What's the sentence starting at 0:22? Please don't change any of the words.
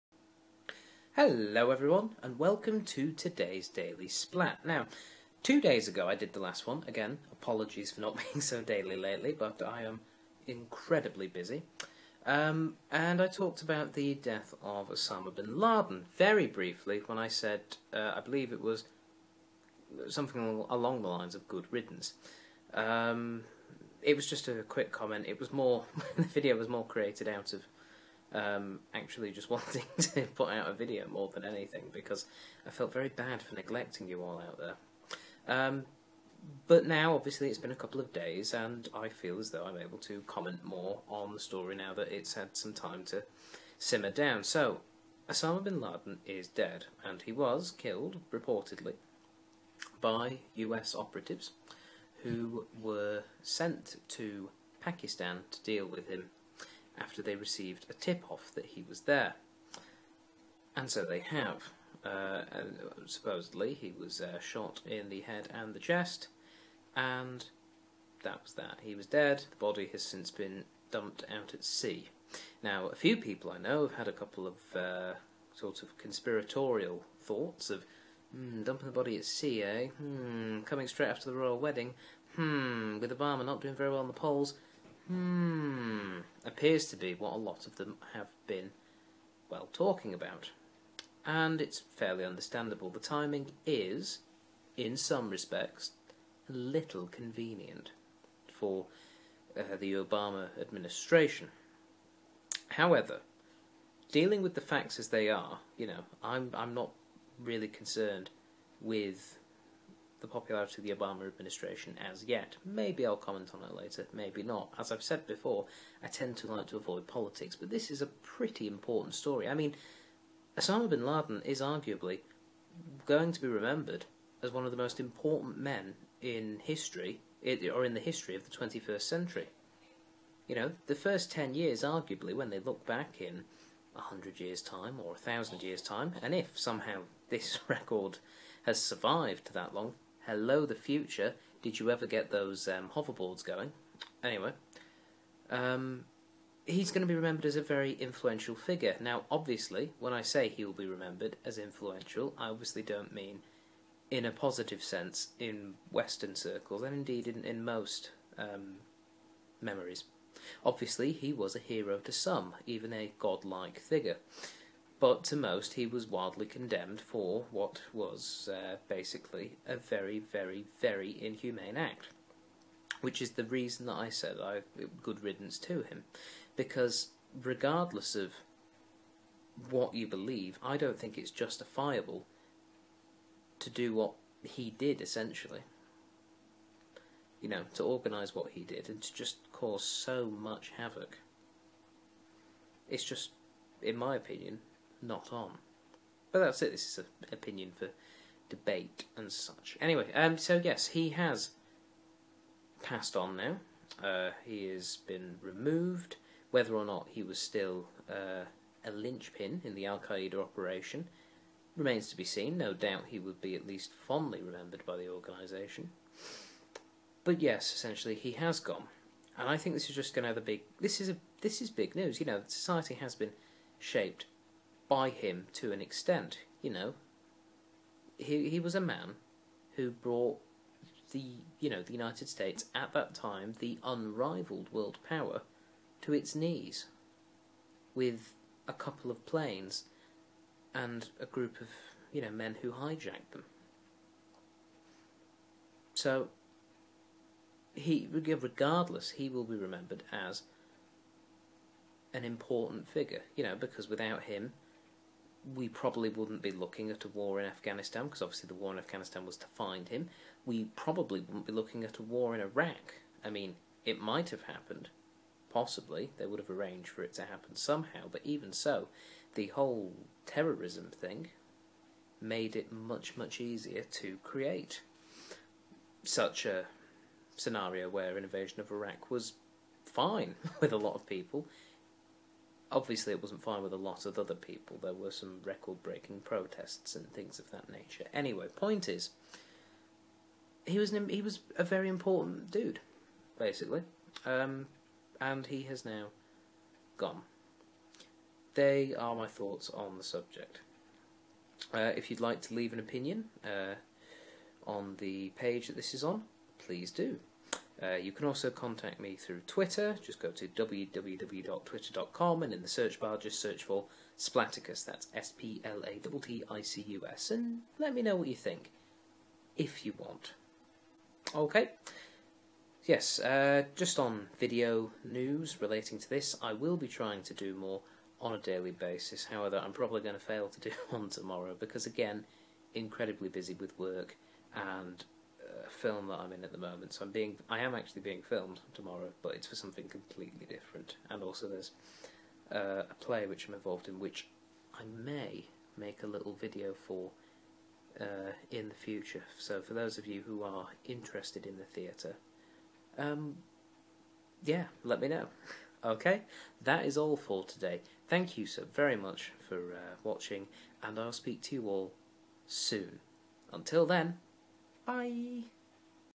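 Um, it was just a quick comment.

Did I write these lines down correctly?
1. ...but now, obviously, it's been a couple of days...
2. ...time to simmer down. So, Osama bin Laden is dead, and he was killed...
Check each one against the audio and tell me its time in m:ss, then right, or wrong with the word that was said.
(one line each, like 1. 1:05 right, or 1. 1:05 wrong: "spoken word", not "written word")
1. 0:36 right
2. 0:42 right.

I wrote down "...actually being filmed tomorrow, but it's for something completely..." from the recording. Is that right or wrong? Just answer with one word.
right.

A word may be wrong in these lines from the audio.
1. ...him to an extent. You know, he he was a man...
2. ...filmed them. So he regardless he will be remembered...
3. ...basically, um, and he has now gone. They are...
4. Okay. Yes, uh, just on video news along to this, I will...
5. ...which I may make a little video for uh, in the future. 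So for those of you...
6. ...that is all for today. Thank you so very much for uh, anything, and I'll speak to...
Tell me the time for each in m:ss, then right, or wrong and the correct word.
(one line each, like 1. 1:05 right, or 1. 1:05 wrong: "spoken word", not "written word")
1. 3:45 right
2. 4:02 wrong: "hijacked", not "filmed"
3. 4:53 right
4. 5:21 wrong: "relating", not "along"
5. 5:43 right
6. 5:56 wrong: "watching", not "anything".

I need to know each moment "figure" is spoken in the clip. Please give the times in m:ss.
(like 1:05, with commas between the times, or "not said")
2:28, 2:43, 4:12.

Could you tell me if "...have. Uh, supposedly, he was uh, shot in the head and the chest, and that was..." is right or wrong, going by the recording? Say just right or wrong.
right.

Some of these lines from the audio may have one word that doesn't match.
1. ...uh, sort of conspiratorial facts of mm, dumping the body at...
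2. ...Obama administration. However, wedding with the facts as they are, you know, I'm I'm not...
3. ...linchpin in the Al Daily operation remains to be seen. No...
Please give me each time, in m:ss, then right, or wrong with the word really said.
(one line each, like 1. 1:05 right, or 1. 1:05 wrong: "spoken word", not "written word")
1. 1:14 wrong: "thoughts", not "facts"
2. 1:39 wrong: "dealing", not "wedding"
3. 3:28 wrong: "Qaeda", not "Daily".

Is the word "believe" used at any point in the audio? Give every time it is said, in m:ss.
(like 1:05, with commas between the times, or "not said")
0:18, 3:00.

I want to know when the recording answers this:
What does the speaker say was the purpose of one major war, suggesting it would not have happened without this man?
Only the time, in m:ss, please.
4:19.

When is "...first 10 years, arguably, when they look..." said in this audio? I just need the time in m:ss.
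2:10.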